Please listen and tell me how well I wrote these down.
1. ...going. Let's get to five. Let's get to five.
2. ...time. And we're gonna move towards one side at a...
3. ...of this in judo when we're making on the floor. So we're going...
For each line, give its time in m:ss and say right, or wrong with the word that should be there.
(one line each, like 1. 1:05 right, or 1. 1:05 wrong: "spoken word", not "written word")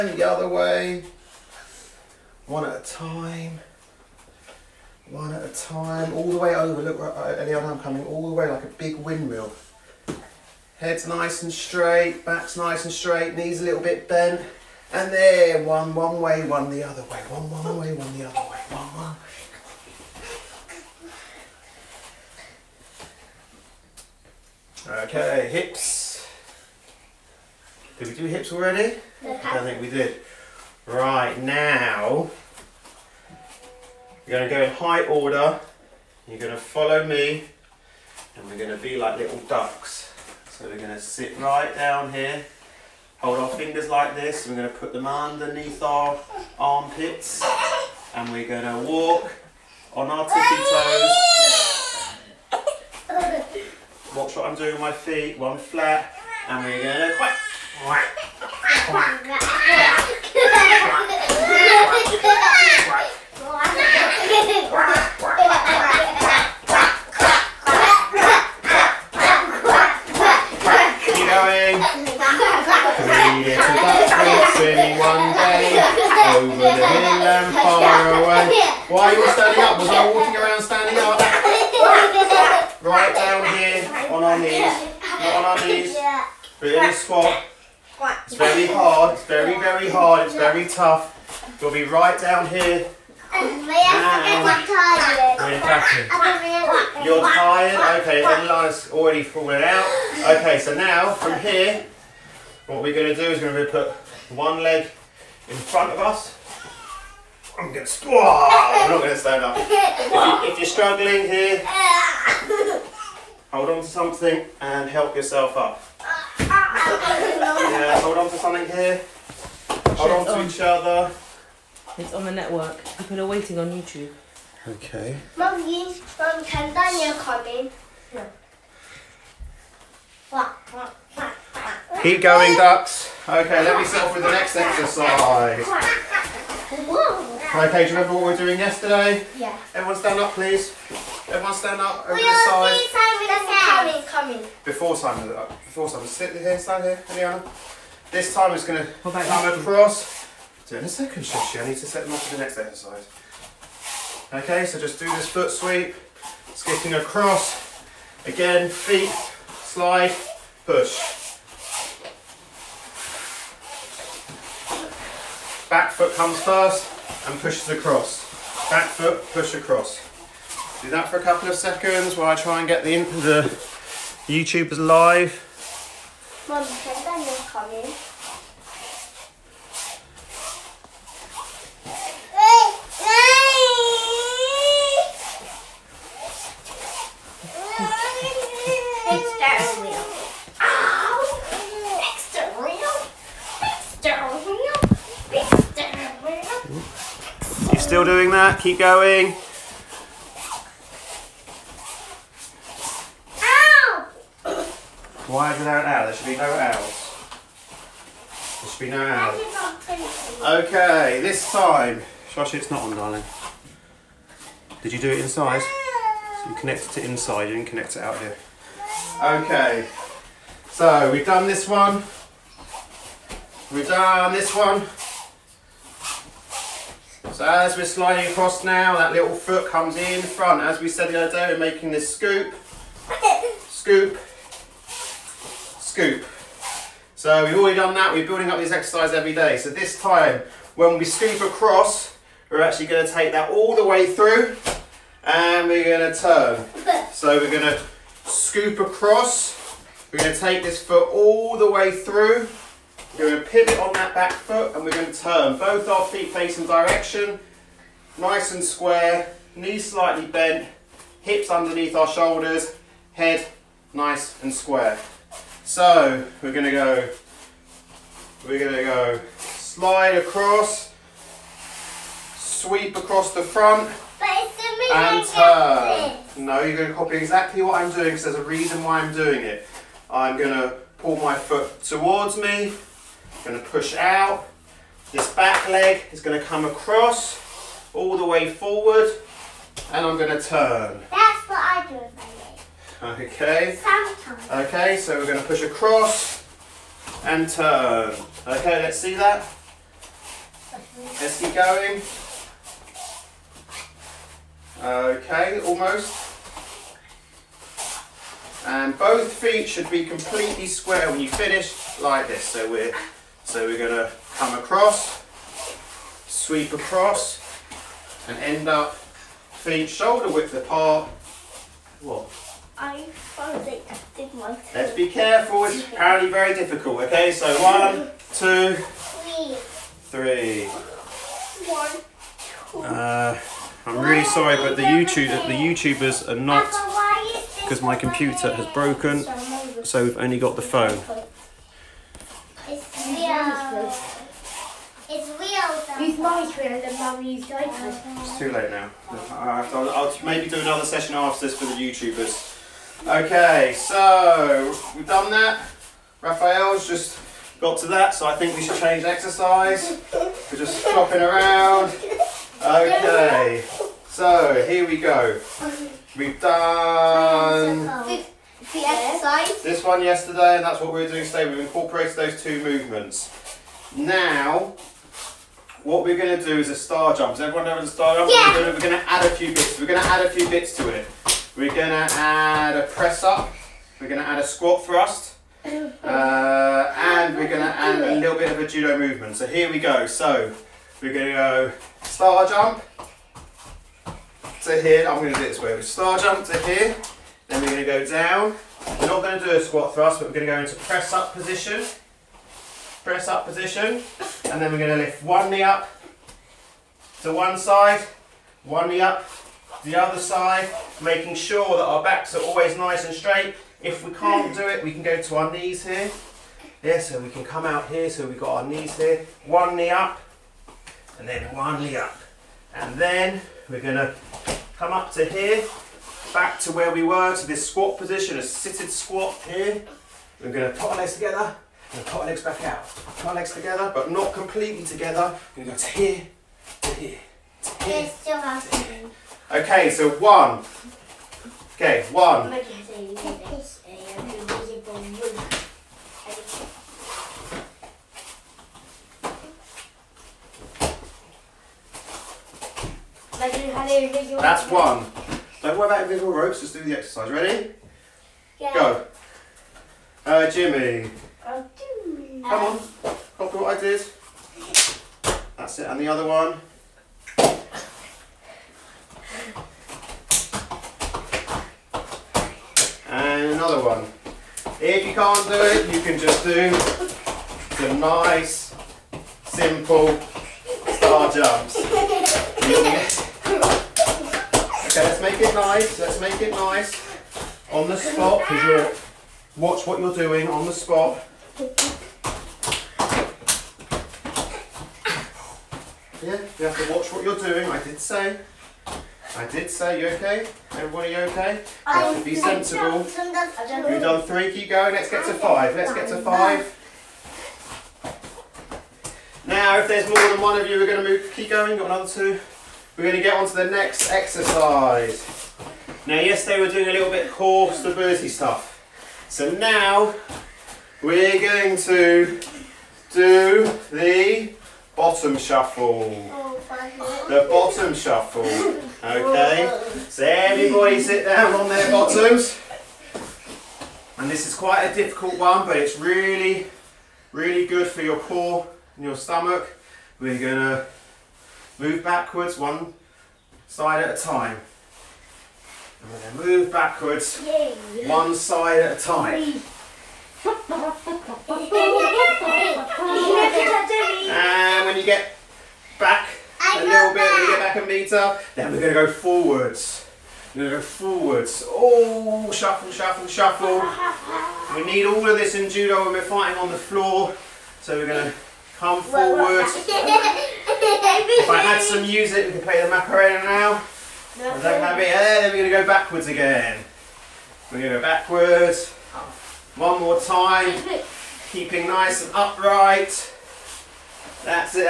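1. 8:24 right
2. 9:04 wrong: "backwards", not "towards"
3. 9:25 wrong: "fighting", not "making".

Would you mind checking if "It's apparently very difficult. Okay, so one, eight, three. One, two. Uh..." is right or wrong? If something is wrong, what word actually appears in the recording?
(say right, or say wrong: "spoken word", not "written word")
wrong: "two", not "eight".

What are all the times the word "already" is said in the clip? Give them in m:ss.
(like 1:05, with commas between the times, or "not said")
0:28, 1:38, 3:57.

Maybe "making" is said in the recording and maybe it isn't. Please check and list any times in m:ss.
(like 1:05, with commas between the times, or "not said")
3:51, 6:51.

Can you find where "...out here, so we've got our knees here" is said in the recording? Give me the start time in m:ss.
6:57.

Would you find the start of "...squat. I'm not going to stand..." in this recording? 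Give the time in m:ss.
1:47.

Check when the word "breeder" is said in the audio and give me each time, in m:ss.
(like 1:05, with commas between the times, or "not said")
not said.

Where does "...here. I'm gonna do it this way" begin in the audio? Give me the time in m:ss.
6:34.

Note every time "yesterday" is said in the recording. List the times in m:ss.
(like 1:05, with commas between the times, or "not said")
2:18, 6:10, 8:36.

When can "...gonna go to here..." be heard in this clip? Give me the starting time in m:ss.
7:15.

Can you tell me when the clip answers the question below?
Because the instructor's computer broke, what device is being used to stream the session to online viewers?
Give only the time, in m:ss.
5:40.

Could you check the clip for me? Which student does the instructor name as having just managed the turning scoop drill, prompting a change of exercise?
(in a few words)
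Raphael.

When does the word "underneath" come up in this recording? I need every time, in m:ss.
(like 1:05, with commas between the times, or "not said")
0:45, 4:21.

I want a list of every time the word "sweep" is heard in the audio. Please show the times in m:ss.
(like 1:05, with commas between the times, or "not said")
2:35, 4:32, 5:16.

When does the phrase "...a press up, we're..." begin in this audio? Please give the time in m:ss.
6:22.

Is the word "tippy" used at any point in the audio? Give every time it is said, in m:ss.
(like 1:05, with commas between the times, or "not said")
0:50.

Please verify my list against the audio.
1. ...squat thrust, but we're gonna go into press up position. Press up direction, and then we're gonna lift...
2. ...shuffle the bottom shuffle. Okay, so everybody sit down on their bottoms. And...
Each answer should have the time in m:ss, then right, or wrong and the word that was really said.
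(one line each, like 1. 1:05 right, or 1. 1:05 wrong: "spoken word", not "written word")
1. 6:39 wrong: "position", not "direction"
2. 8:45 right.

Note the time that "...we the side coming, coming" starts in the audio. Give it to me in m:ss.
2:22.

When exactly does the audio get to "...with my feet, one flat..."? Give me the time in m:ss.
0:54.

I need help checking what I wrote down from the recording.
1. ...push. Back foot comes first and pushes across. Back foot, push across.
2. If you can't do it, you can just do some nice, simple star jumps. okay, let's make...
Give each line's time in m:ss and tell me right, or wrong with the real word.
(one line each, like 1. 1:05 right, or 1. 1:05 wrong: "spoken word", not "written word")
1. 2:40 right
2. 7:54 right.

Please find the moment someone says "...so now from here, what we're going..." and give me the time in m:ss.
1:40.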